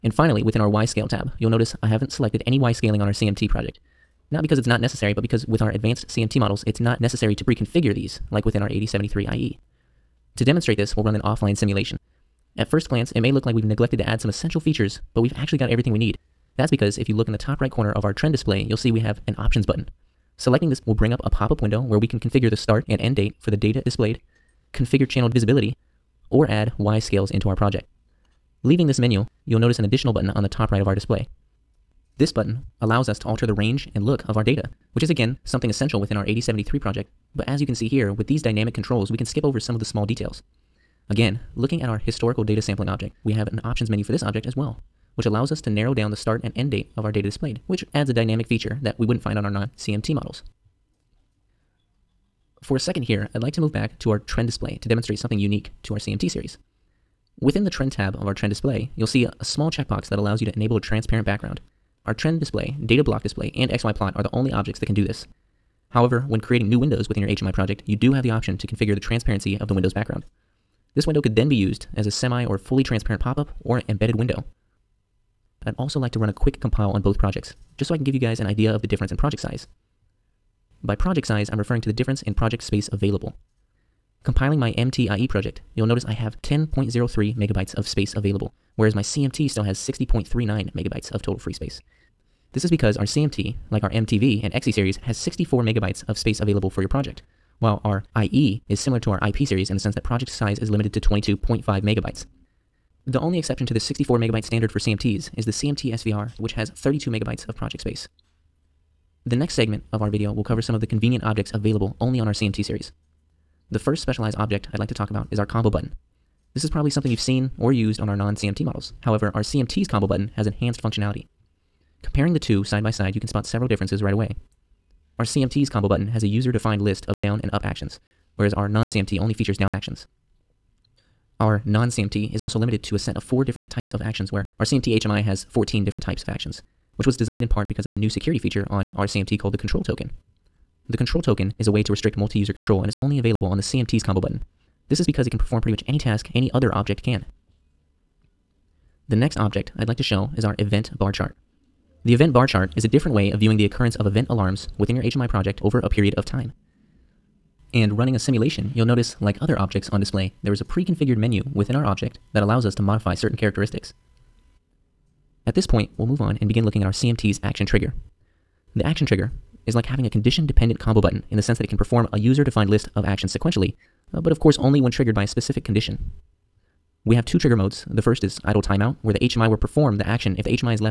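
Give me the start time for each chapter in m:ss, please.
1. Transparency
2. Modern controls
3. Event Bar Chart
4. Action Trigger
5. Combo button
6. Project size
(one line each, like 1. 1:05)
1. 0:56
2. 0:45
3. 2:27
4. 2:48
5. 1:52
6. 1:14.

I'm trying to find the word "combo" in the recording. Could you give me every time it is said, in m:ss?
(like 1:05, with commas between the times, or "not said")
1:55, 1:59, 2:05, 2:24, 2:50.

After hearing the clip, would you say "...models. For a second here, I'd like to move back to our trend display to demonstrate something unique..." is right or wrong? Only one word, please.
right.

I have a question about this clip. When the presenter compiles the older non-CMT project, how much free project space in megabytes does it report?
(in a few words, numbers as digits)
10.03 megabytes.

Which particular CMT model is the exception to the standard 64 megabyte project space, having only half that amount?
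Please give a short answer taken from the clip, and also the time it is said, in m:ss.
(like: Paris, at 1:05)
CMT SVR, at 1:45.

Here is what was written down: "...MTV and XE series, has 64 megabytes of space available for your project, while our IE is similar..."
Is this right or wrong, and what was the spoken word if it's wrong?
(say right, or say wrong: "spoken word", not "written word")
right.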